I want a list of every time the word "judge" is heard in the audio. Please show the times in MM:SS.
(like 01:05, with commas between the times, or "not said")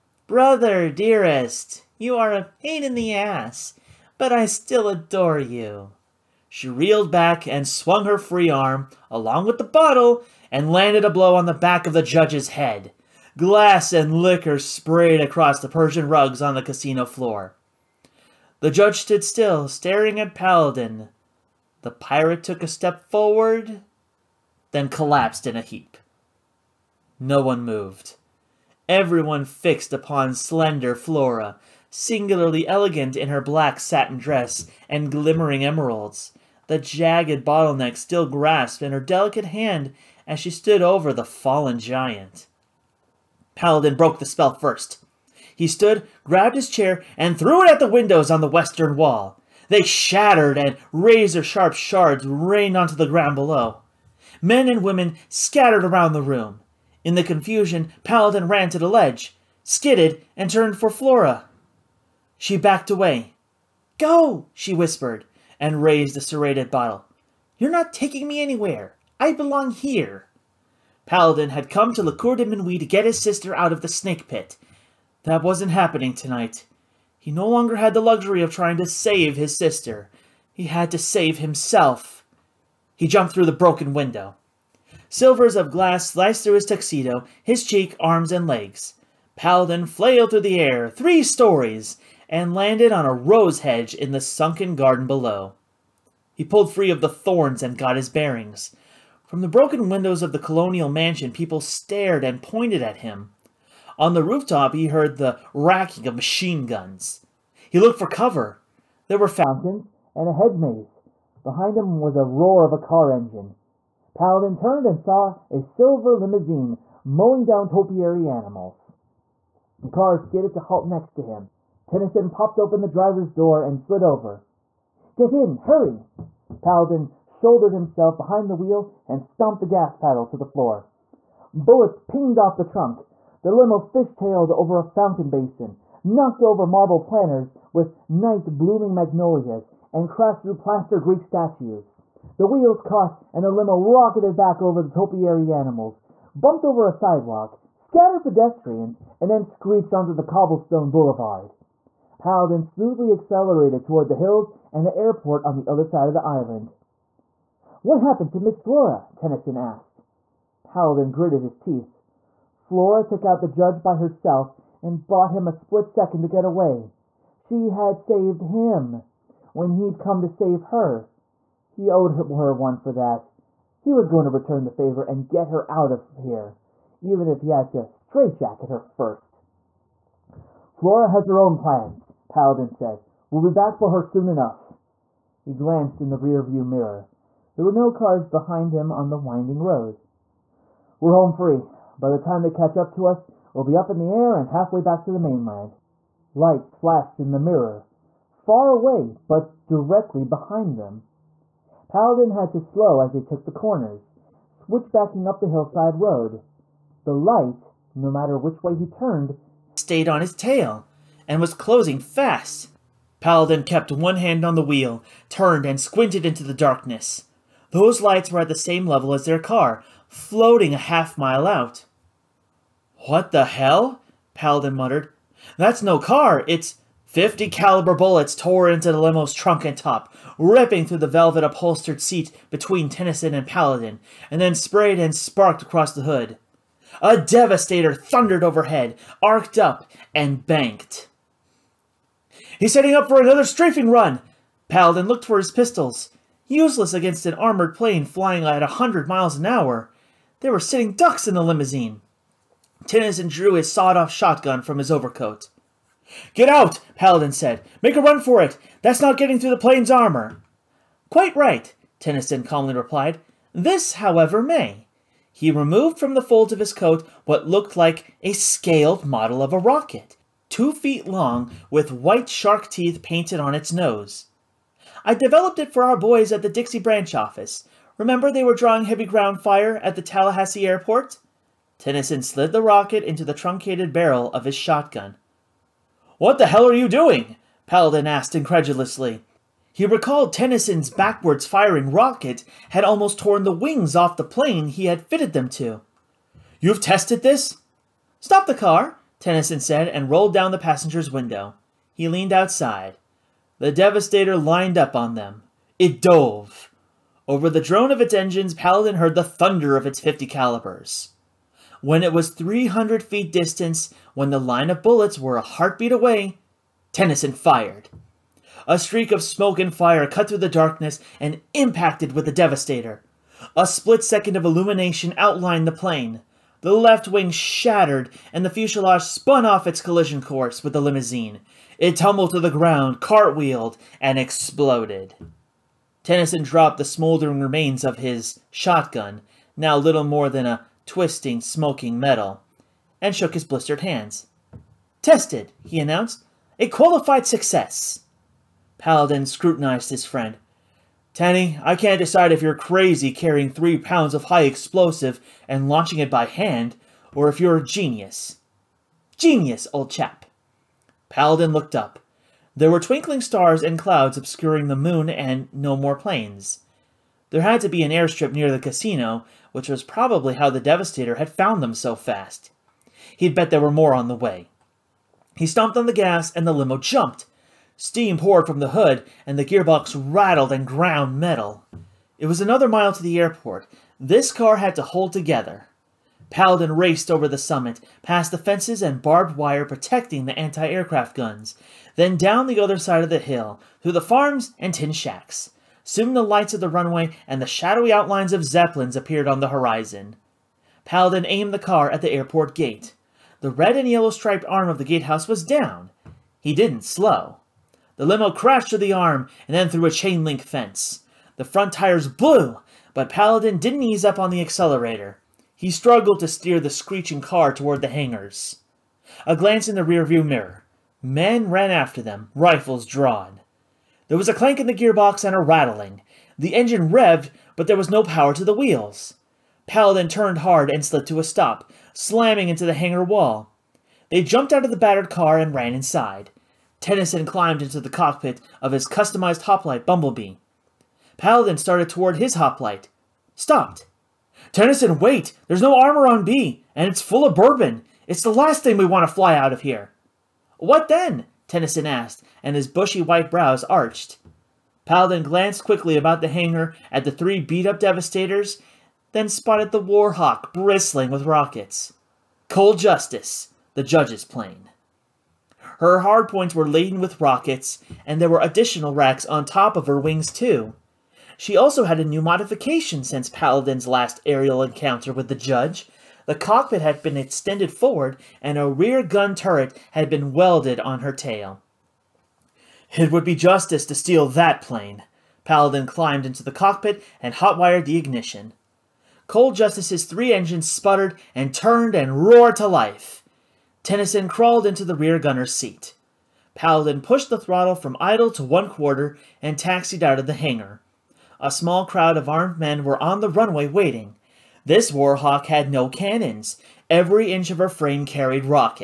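00:12, 00:18, 02:43, 07:43, 07:55.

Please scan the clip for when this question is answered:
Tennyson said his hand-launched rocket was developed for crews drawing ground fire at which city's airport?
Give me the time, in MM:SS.
04:40.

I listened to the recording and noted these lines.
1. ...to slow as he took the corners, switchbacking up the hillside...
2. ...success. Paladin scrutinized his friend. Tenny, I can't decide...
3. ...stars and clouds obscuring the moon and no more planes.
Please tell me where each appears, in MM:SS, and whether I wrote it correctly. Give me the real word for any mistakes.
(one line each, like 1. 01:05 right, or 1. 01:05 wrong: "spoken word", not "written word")
1. 03:22 right
2. 05:47 right
3. 06:03 right.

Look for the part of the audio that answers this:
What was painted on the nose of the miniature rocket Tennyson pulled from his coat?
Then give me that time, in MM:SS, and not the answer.
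04:31.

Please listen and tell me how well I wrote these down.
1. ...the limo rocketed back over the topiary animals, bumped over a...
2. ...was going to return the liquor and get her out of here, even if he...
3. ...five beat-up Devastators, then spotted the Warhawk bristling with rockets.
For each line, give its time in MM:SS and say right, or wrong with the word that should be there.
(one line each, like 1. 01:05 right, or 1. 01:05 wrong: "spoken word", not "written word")
1. 02:23 right
2. 02:53 wrong: "favor", not "liquor"
3. 07:37 wrong: "three", not "five".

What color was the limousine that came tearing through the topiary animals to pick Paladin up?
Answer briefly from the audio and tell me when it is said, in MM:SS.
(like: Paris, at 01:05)
silver, at 01:55.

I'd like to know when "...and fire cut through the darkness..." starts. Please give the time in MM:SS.
05:19.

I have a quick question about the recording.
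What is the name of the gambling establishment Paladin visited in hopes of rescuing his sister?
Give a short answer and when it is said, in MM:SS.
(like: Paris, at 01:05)
Le Cour de Minuit, at 01:12.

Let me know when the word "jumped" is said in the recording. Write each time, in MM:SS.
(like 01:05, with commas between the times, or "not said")
01:23, 06:16, 07:14.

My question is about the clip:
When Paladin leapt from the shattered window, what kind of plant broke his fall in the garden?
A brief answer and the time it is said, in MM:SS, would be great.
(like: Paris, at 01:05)
rose hedge, at 01:33.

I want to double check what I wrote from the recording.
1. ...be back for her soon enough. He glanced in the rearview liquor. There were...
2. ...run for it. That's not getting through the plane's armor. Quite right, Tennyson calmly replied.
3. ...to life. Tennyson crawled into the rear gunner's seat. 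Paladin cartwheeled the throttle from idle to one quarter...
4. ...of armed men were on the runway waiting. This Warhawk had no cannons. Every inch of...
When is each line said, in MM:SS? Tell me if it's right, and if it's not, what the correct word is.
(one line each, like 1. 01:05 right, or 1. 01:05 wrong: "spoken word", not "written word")
1. 03:03 wrong: "mirror", not "liquor"
2. 04:18 right
3. 08:12 wrong: "pushed", not "cartwheeled"
4. 08:22 right.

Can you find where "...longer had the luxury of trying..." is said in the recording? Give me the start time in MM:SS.
01:17.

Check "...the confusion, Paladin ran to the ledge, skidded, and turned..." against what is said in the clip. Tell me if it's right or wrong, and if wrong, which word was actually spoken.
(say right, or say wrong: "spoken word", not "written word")
right.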